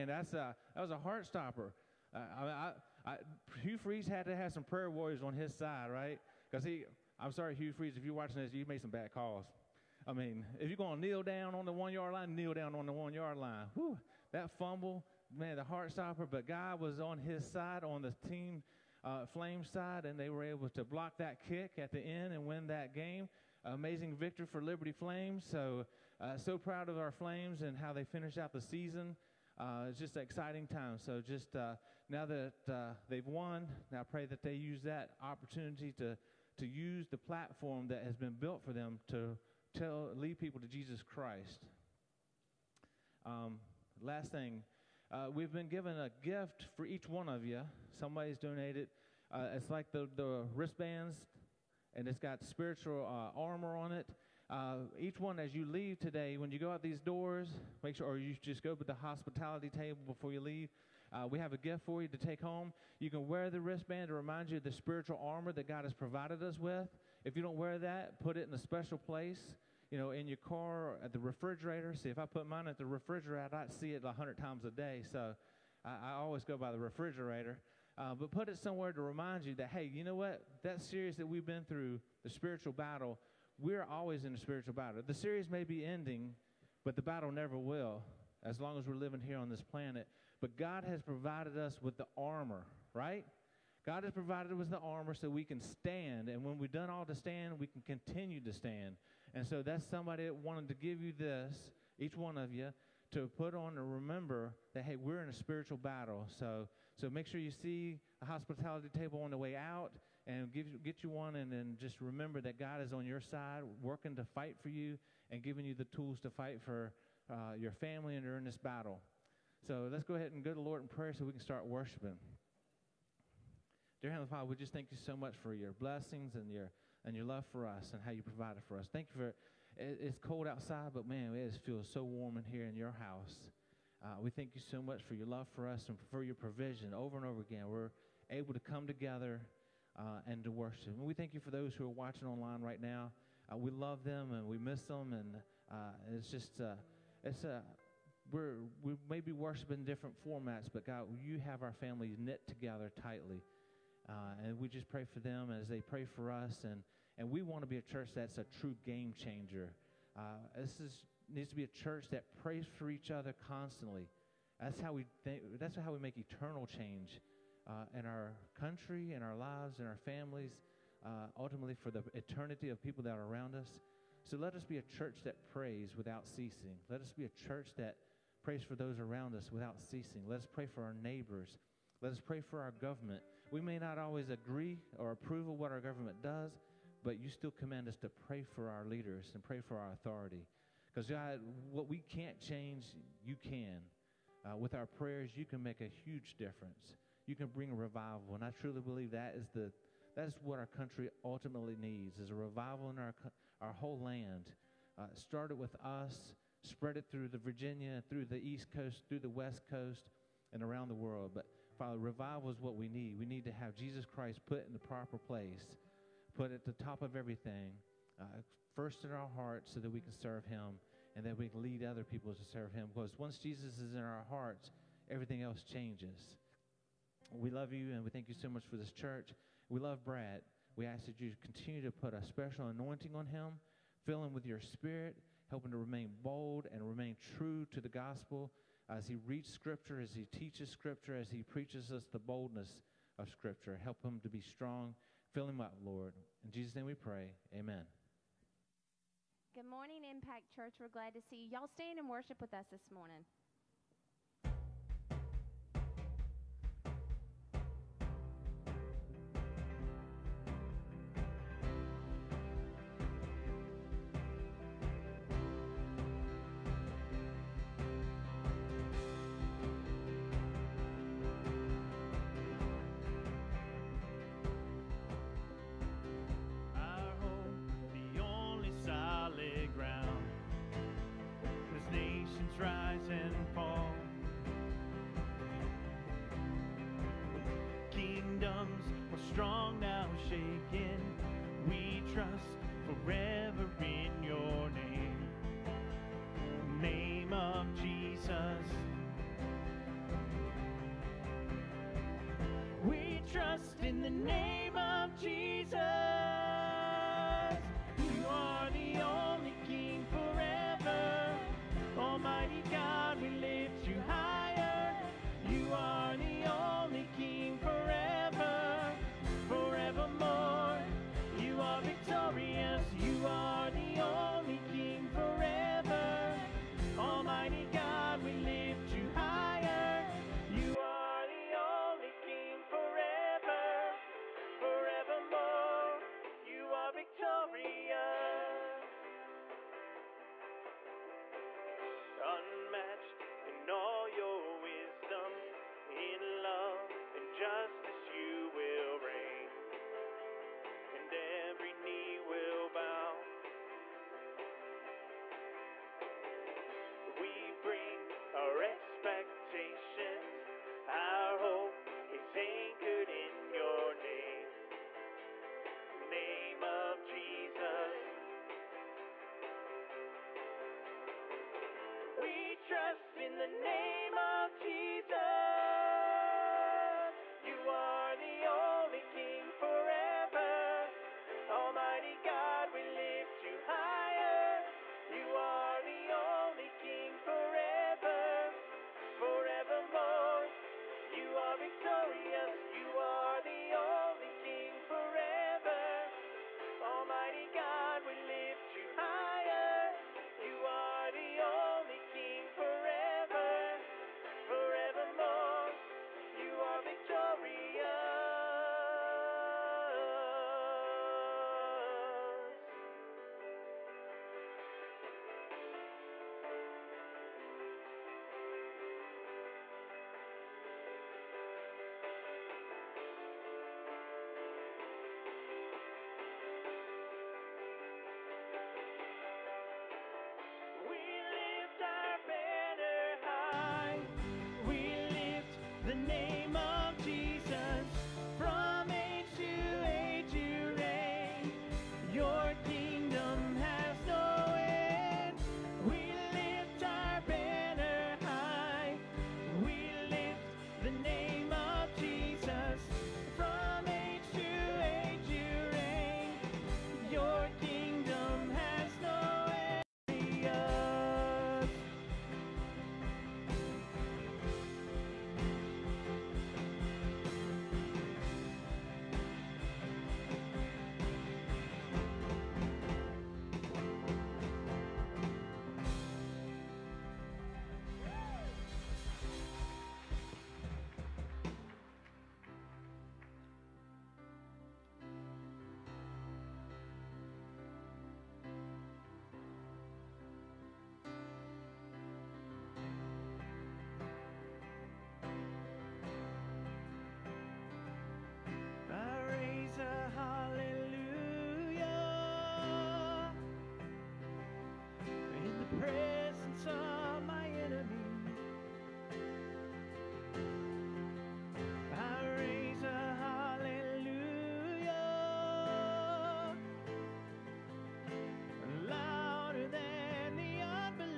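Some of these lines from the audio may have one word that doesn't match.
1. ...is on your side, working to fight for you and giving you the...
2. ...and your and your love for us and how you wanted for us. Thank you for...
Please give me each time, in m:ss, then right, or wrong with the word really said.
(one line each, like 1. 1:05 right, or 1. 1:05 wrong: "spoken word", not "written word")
1. 1:52 right
2. 2:06 wrong: "provided", not "wanted".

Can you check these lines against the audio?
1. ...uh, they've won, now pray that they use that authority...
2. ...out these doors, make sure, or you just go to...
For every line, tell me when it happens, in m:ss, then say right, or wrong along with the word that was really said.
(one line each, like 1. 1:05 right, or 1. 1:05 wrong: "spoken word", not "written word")
1. 0:32 wrong: "opportunity", not "authority"
2. 0:56 right.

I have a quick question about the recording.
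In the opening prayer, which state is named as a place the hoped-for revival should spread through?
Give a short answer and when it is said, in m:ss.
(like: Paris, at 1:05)
Virginia, at 3:27.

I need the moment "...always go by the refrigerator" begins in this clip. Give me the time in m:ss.
1:16.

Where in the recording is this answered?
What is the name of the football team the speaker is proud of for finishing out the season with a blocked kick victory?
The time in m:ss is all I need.
0:24.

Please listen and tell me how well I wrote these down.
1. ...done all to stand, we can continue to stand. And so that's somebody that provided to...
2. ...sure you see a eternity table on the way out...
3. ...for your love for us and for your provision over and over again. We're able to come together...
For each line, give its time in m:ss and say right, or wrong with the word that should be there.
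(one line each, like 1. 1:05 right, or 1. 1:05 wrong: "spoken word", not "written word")
1. 1:36 wrong: "wanted", not "provided"
2. 1:47 wrong: "hospitality", not "eternity"
3. 2:15 right.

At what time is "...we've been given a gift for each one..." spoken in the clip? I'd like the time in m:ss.
0:45.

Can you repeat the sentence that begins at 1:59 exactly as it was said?
So let's go ahead and go to the Lord in prayer so we can start worshiping.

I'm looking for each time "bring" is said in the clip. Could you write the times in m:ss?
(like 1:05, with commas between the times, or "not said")
3:17.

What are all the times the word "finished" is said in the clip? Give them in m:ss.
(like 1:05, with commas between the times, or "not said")
0:28.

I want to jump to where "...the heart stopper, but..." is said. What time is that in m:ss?
0:15.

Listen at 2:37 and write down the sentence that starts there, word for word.
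And we want to be a church that's a true game changer.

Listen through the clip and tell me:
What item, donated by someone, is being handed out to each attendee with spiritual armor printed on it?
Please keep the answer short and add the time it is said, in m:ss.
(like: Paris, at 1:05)
wristbands, at 0:50.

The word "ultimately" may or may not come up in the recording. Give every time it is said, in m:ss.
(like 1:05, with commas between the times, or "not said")
2:51, 3:21.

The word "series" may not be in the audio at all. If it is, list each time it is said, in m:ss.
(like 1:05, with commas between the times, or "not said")
1:20, 1:25.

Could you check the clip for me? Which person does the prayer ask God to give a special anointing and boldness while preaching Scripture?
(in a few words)
Brad.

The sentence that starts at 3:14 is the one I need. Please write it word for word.
Uh, with our prayers, you can make a huge difference.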